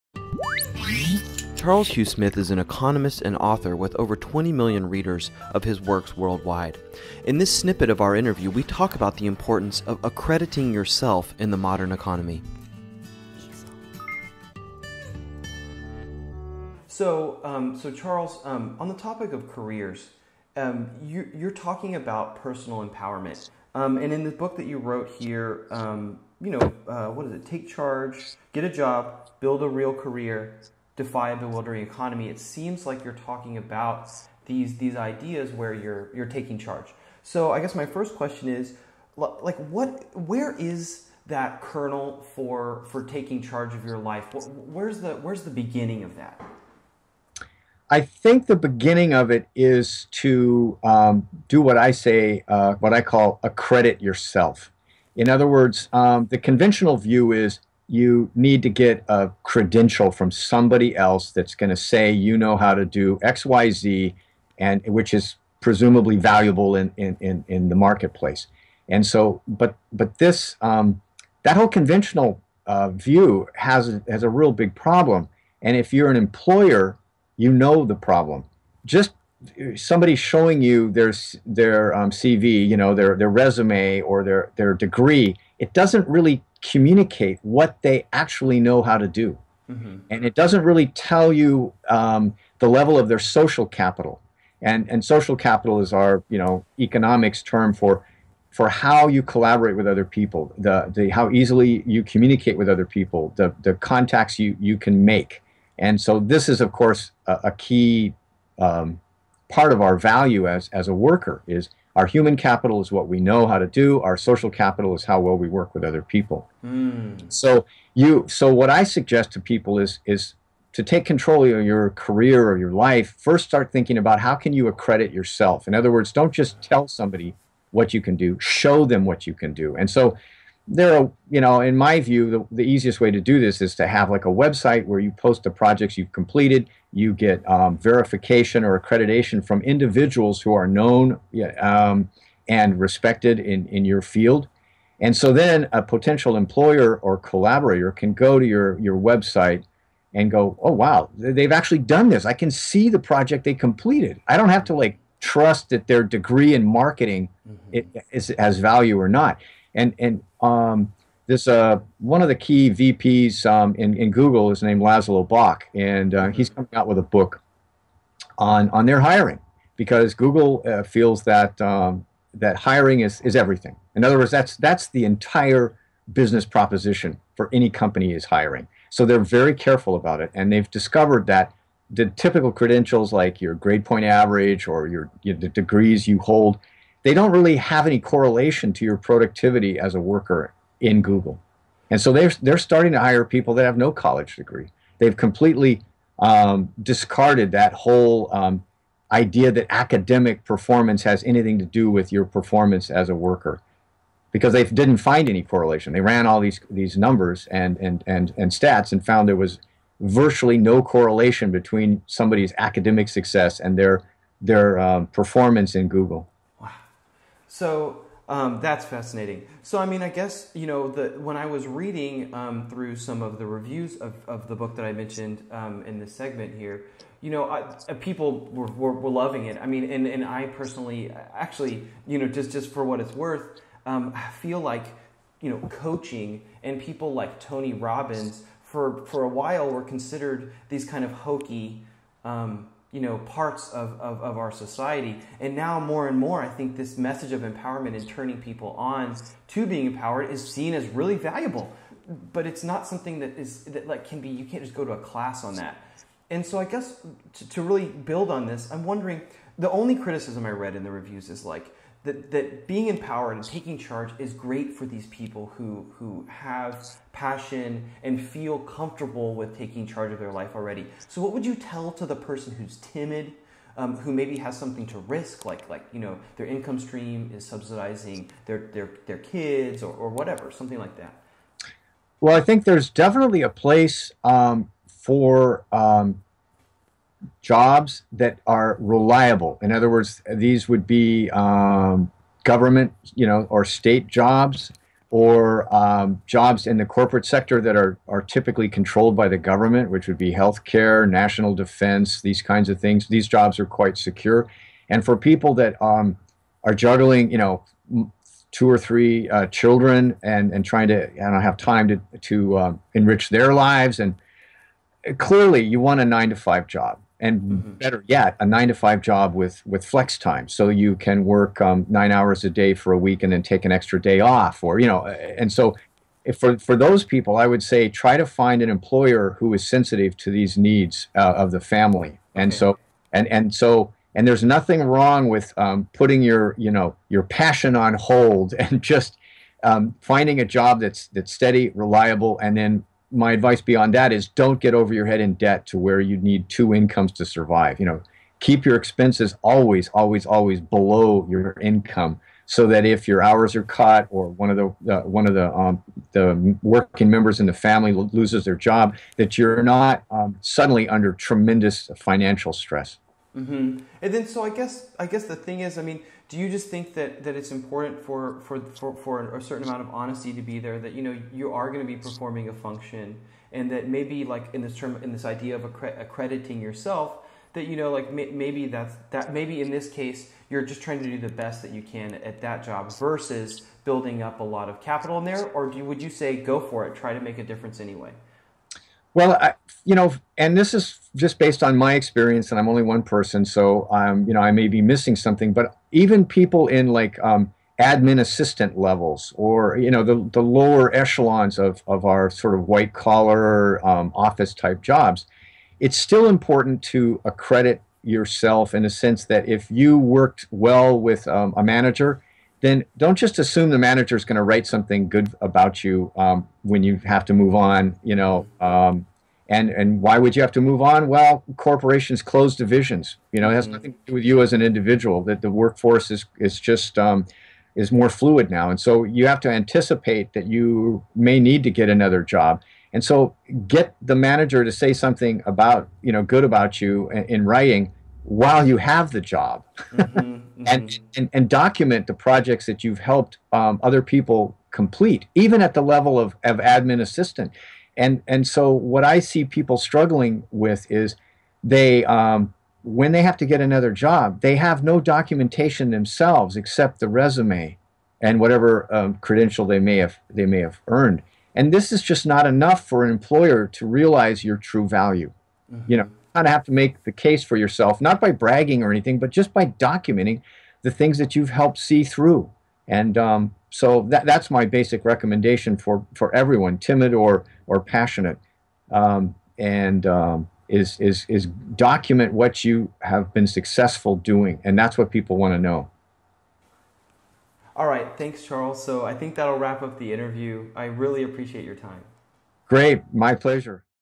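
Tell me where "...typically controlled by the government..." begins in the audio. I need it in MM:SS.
04:58.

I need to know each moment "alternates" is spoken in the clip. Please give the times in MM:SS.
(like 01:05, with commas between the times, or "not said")
not said.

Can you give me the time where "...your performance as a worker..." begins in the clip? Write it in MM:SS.
03:22.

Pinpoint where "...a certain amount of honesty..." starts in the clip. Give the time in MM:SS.
06:09.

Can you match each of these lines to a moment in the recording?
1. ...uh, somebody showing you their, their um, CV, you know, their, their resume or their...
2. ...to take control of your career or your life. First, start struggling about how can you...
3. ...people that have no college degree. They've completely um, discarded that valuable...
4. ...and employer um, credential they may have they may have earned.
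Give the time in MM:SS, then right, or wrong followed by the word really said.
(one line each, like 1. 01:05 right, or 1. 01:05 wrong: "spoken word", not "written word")
1. 01:19 right
2. 02:00 wrong: "thinking", not "struggling"
3. 03:13 wrong: "whole", not "valuable"
4. 07:38 wrong: "whatever", not "employer".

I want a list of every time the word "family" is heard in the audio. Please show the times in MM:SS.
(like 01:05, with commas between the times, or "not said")
05:31, 05:57.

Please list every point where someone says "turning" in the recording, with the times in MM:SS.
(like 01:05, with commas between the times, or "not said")
04:08.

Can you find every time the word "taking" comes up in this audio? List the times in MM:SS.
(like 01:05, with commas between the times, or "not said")
00:36, 00:43, 04:23, 04:29.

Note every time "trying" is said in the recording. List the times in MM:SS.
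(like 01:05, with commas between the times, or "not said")
05:10, 06:20.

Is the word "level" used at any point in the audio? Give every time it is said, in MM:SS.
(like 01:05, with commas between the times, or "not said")
01:32, 06:38, 07:25.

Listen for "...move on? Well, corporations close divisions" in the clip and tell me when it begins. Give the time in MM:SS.
07:00.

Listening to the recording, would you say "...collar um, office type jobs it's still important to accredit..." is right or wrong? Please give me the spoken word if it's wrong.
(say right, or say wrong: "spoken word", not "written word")
right.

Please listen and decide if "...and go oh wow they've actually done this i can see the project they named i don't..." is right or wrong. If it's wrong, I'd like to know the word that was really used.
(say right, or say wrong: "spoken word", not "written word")
wrong: "completed", not "named".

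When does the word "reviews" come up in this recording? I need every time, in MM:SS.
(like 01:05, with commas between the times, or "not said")
03:43, 04:20.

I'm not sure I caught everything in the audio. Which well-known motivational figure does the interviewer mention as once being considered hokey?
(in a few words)
Tony Robbins.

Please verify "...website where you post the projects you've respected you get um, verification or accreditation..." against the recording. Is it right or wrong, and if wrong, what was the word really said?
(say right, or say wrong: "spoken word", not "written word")
wrong: "completed", not "respected".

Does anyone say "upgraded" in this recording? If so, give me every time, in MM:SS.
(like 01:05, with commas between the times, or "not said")
not said.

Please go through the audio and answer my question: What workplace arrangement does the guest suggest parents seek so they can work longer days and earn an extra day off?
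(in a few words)
flex time.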